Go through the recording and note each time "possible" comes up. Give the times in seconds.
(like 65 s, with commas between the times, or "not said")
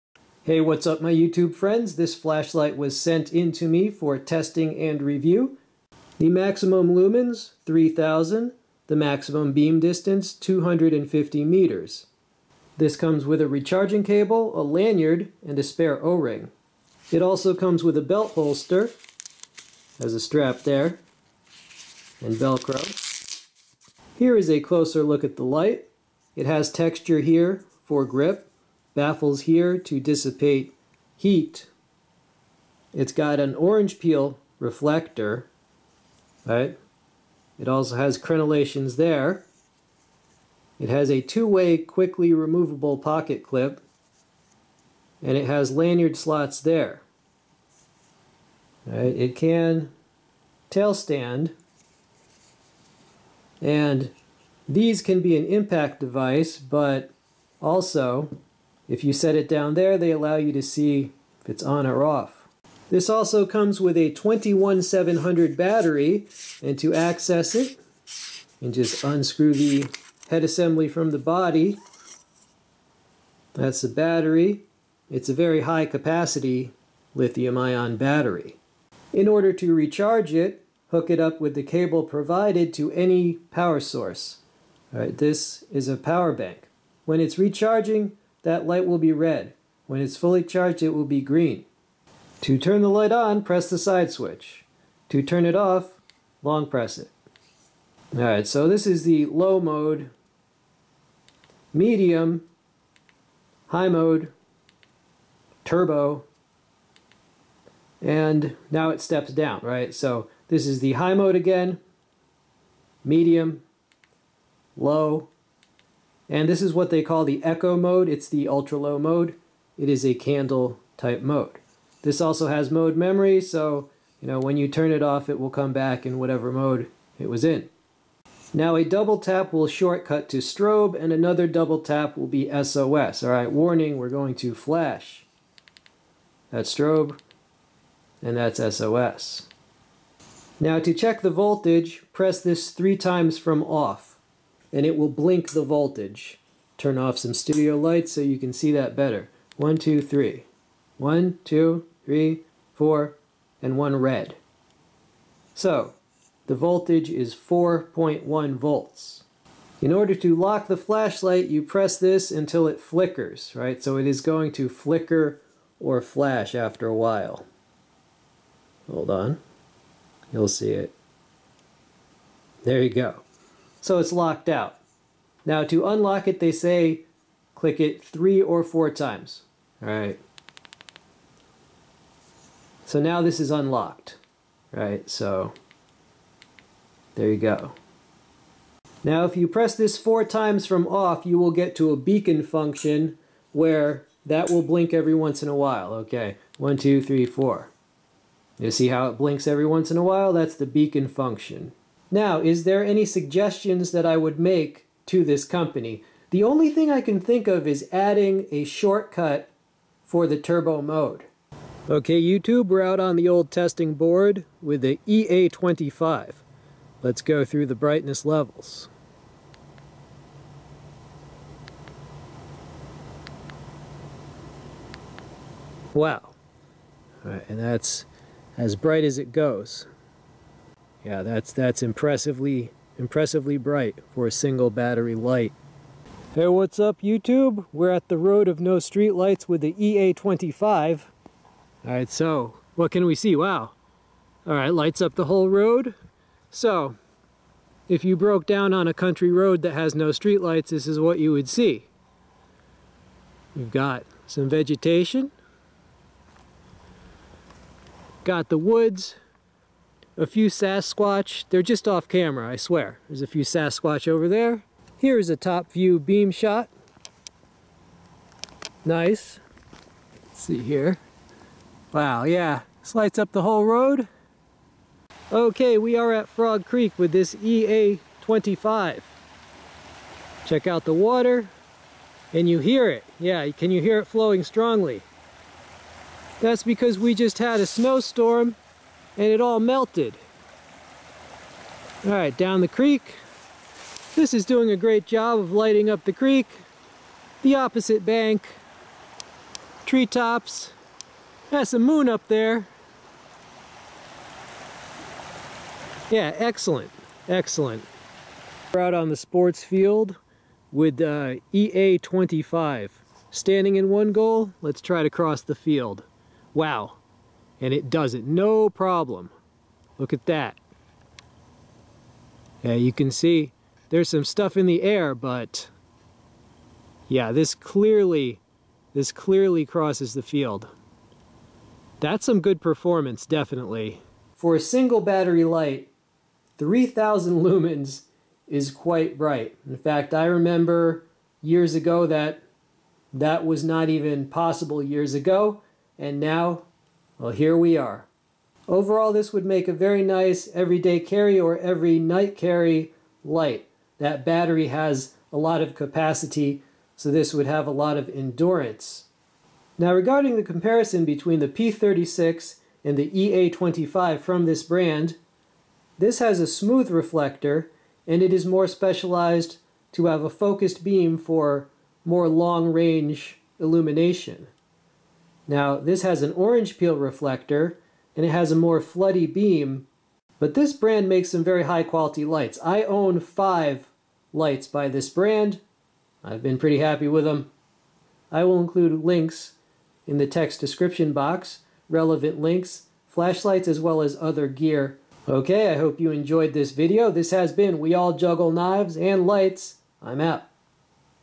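344 s.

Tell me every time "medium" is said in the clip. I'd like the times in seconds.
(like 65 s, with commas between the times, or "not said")
101 s, 113 s.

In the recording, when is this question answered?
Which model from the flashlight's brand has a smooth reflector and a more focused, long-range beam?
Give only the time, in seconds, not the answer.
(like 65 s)
361 s.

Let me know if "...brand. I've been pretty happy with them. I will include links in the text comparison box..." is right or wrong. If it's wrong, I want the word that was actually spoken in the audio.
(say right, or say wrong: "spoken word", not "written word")
wrong: "description", not "comparison".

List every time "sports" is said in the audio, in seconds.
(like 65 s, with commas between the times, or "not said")
309 s.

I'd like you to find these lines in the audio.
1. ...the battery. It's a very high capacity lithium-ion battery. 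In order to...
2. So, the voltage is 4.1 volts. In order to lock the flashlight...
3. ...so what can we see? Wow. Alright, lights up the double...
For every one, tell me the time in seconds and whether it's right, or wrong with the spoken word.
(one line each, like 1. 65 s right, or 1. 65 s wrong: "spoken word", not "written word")
1. 73 s right
2. 155 s right
3. 242 s wrong: "whole", not "double".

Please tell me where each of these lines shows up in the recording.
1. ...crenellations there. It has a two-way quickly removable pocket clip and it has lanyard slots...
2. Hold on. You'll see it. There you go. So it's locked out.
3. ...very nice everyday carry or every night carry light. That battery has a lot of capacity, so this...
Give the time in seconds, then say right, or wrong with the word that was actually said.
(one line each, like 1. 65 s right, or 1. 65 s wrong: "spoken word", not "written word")
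1. 38 s right
2. 168 s right
3. 349 s right.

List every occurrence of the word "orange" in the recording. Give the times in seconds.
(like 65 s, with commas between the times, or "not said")
33 s, 376 s.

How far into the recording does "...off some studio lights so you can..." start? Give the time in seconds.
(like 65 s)
146 s.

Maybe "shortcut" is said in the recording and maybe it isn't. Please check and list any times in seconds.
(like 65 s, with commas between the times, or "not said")
129 s, 208 s.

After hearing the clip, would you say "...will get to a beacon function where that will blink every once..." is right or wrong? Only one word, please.
right.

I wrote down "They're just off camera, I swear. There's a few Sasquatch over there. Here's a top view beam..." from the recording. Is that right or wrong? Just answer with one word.
right.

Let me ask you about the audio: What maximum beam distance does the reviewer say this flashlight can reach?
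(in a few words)
250 meters.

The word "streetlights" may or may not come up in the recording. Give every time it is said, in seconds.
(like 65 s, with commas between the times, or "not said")
238 s, 250 s.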